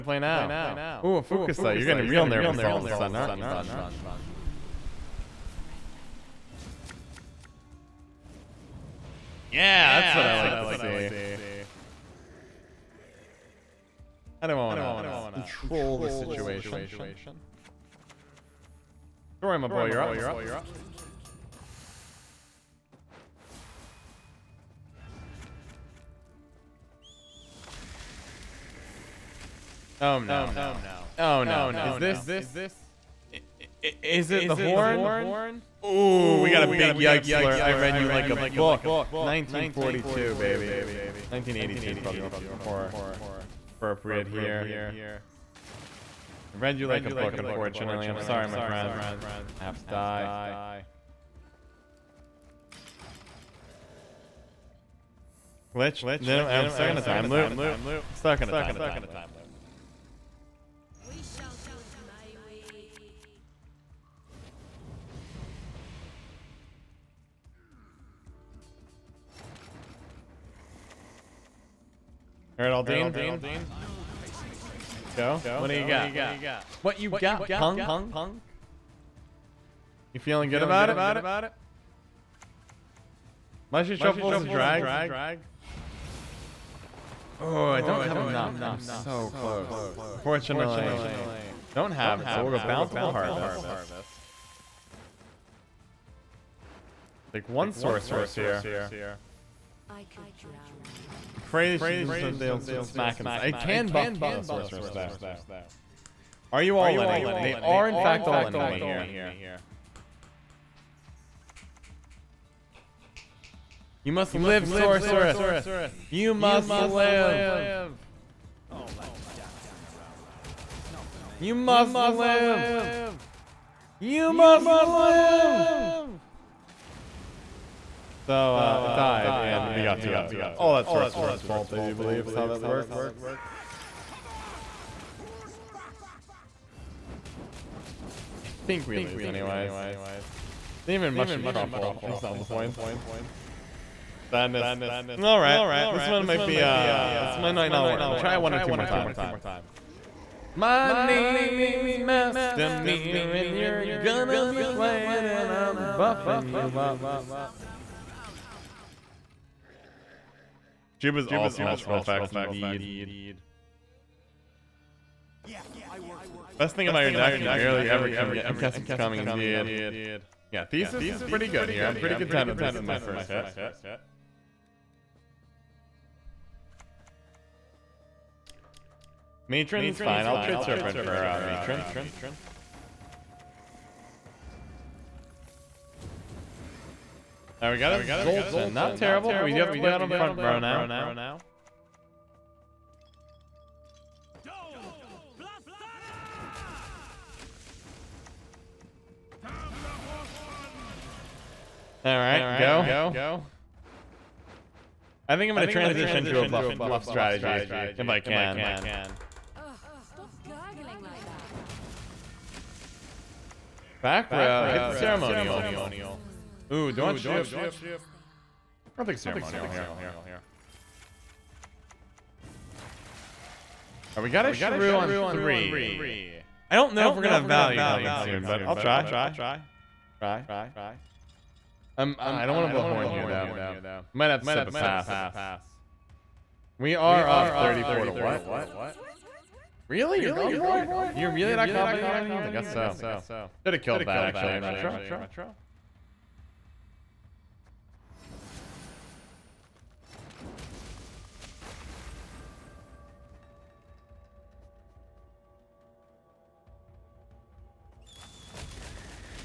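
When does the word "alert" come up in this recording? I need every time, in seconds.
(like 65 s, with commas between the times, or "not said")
37 s.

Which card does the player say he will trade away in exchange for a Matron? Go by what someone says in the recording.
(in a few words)
Serpent.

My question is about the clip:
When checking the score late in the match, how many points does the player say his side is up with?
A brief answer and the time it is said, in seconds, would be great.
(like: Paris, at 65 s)
34, at 237 s.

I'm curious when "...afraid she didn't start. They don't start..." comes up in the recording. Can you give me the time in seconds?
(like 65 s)
101 s.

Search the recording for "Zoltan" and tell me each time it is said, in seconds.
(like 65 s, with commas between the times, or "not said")
188 s.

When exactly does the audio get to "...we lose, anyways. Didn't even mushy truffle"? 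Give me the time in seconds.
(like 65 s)
138 s.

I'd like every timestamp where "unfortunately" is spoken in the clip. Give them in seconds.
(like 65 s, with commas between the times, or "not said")
47 s, 90 s.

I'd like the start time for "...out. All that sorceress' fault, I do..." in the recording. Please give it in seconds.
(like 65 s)
130 s.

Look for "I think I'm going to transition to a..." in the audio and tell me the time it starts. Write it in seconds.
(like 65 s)
205 s.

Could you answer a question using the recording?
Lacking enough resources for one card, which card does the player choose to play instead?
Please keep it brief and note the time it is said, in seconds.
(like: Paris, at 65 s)
Bountiful Harvest, at 92 s.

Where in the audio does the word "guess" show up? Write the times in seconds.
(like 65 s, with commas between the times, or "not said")
168 s, 242 s.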